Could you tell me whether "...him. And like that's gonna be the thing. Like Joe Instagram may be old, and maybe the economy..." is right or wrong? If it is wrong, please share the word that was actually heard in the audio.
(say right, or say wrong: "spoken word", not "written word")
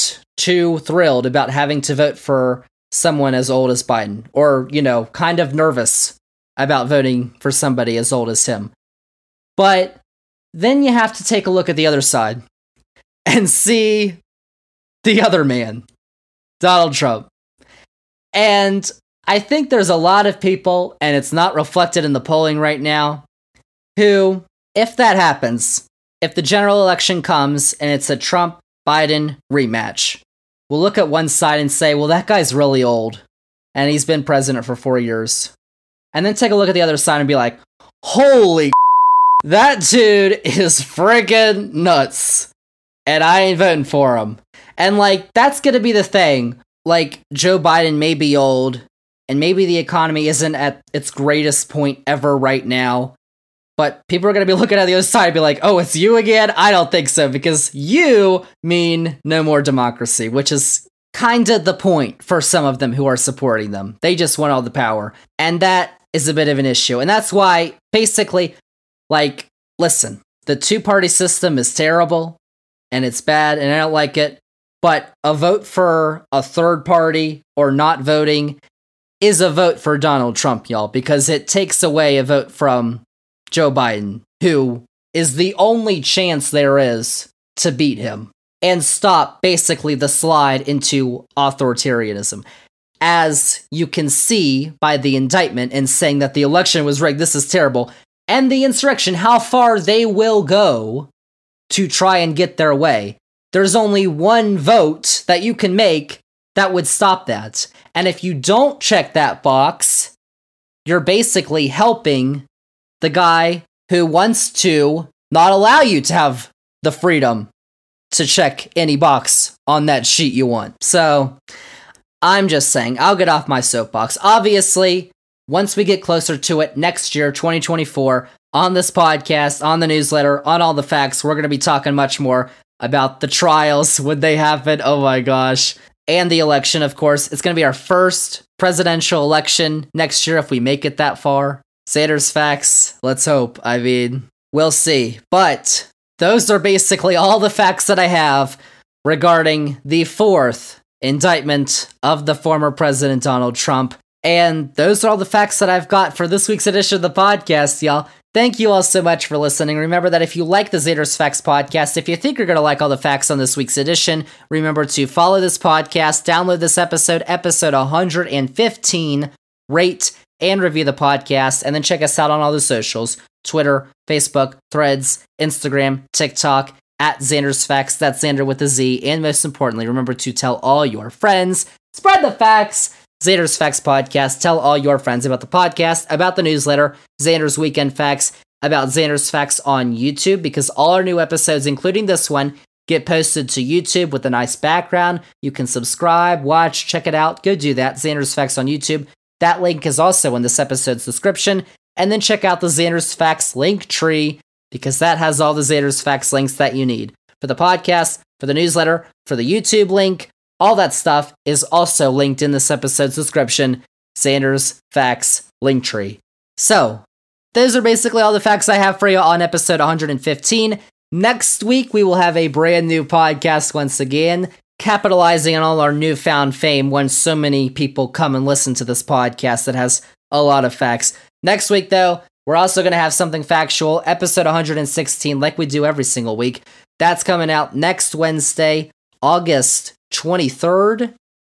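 wrong: "Biden", not "Instagram".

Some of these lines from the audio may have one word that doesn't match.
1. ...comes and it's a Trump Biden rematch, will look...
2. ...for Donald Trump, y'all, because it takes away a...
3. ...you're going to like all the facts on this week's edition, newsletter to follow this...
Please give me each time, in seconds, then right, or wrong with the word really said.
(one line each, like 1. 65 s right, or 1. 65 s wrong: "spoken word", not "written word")
1. 27 s right
2. 79 s right
3. 162 s wrong: "remember", not "newsletter".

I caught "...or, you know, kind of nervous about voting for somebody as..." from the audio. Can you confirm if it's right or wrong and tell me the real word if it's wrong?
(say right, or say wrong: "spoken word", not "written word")
right.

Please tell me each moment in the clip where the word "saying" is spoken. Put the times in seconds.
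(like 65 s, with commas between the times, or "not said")
95 s, 122 s.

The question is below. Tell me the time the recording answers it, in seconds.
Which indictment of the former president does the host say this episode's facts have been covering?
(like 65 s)
150 s.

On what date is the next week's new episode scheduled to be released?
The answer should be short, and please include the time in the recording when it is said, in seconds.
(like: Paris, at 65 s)
August 23rd, at 239 s.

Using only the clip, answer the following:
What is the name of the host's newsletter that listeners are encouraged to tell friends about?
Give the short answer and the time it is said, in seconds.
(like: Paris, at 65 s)
Zander's Weekend Facts, at 187 s.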